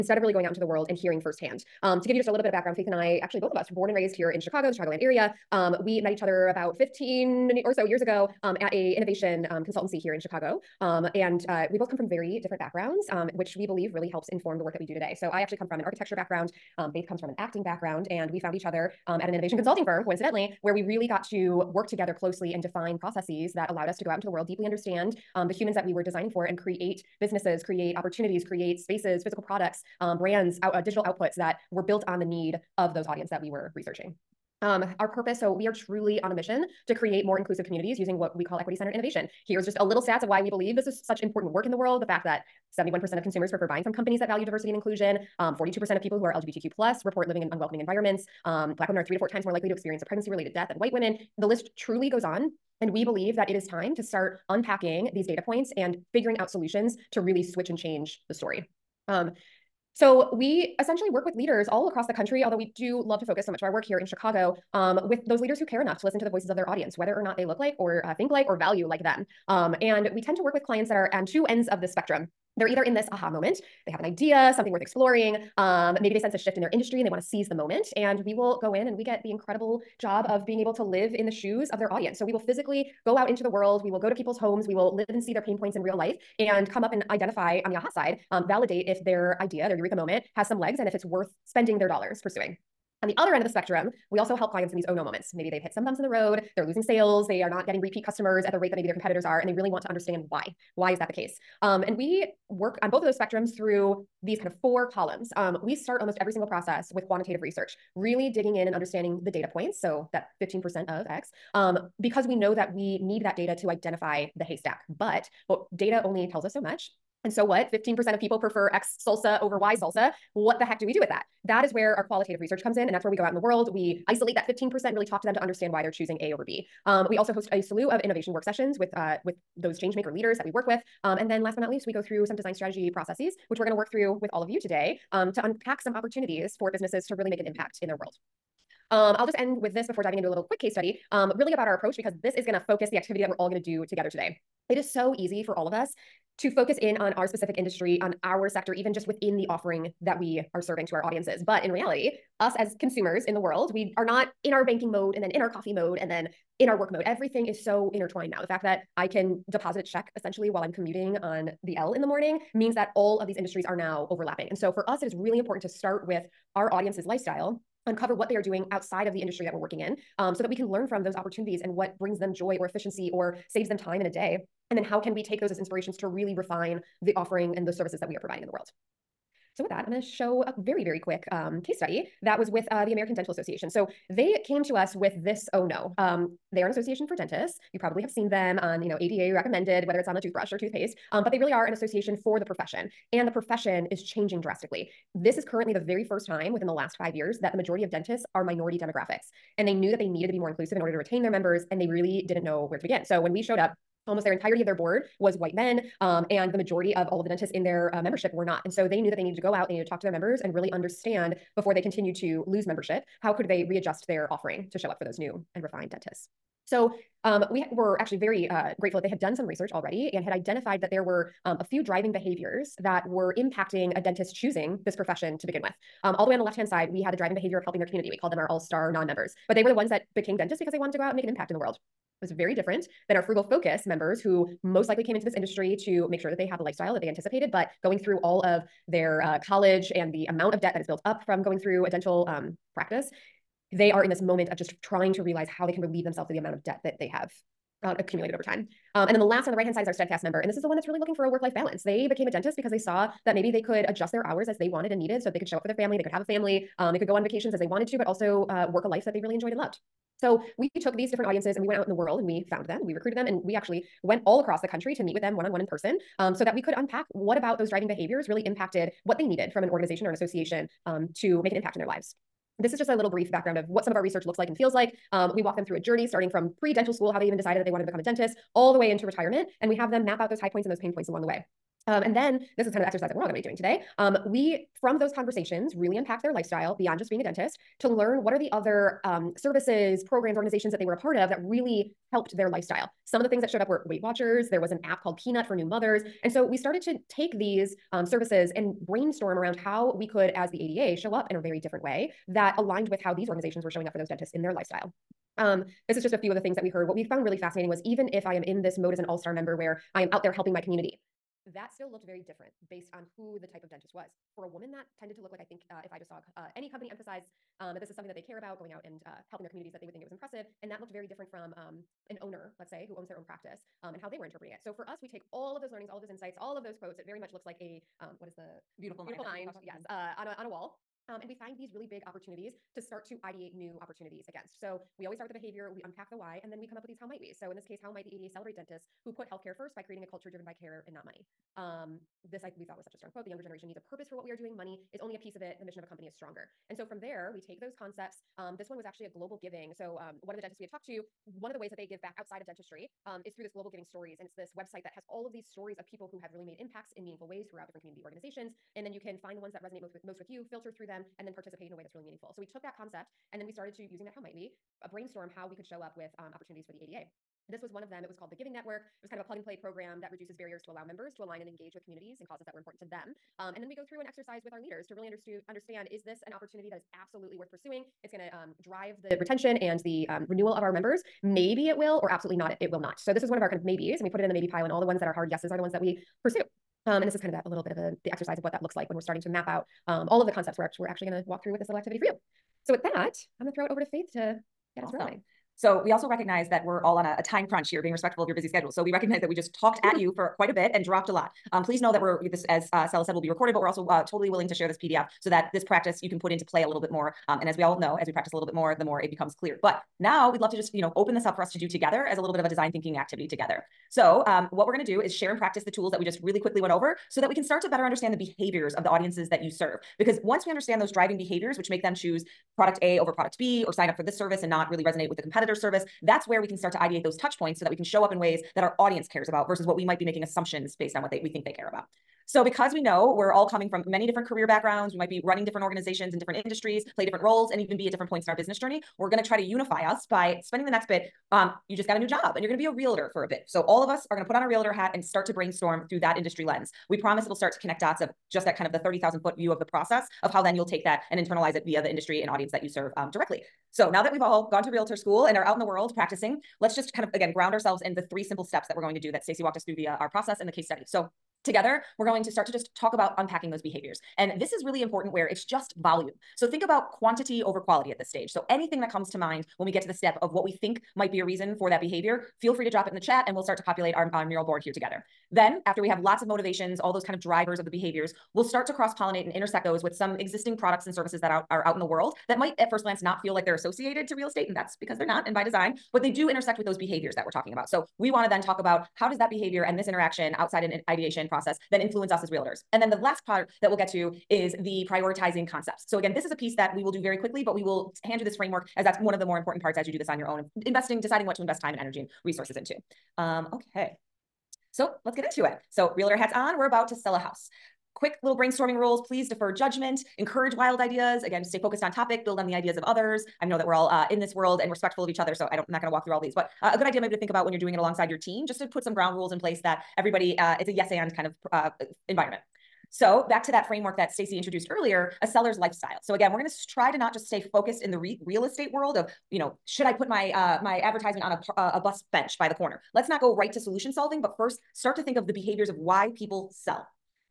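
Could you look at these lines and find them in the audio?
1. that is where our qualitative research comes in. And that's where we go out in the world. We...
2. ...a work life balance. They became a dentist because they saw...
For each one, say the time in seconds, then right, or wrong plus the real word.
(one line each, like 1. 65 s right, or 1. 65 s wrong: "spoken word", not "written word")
1. 121 s right
2. 251 s right.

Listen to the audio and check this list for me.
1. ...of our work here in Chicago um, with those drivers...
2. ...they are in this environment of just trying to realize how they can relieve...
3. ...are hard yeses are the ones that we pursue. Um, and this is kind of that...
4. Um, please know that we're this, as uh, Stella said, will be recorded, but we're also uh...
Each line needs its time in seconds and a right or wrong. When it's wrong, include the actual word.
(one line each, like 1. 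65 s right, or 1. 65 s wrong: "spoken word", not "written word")
1. 63 s wrong: "leaders", not "drivers"
2. 243 s wrong: "moment", not "environment"
3. 385 s right
4. 401 s right.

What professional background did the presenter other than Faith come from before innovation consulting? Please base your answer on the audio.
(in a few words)
architecture.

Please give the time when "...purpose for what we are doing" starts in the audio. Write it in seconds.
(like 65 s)
343 s.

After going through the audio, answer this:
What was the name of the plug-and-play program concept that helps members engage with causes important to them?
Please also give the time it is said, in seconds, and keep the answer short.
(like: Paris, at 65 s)
Giving Network, at 368 s.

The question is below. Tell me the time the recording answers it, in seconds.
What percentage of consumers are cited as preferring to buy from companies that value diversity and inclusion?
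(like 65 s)
42 s.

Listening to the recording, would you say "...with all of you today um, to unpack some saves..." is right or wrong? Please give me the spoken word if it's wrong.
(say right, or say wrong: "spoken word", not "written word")
wrong: "opportunities", not "saves".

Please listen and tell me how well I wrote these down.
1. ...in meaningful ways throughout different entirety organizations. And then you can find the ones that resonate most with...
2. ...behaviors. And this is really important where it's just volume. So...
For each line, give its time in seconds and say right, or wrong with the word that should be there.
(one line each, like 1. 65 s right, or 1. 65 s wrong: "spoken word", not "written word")
1. 356 s wrong: "community", not "entirety"
2. 463 s right.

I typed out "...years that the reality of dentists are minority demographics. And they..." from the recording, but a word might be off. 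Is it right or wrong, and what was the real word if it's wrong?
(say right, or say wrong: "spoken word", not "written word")
wrong: "majority", not "reality".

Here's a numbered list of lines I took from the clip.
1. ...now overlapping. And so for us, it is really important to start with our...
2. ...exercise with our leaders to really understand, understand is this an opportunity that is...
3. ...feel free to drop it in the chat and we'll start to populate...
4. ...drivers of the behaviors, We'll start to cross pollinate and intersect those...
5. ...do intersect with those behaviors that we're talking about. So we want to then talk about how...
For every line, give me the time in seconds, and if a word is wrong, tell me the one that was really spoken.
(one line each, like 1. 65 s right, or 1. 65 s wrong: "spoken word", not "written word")
1. 163 s right
2. 374 s right
3. 472 s right
4. 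477 s right
5. 486 s right.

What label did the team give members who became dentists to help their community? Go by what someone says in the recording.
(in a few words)
all star non members.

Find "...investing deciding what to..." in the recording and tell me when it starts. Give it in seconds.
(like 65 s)
500 s.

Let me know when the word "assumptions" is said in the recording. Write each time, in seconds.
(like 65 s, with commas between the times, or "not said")
430 s.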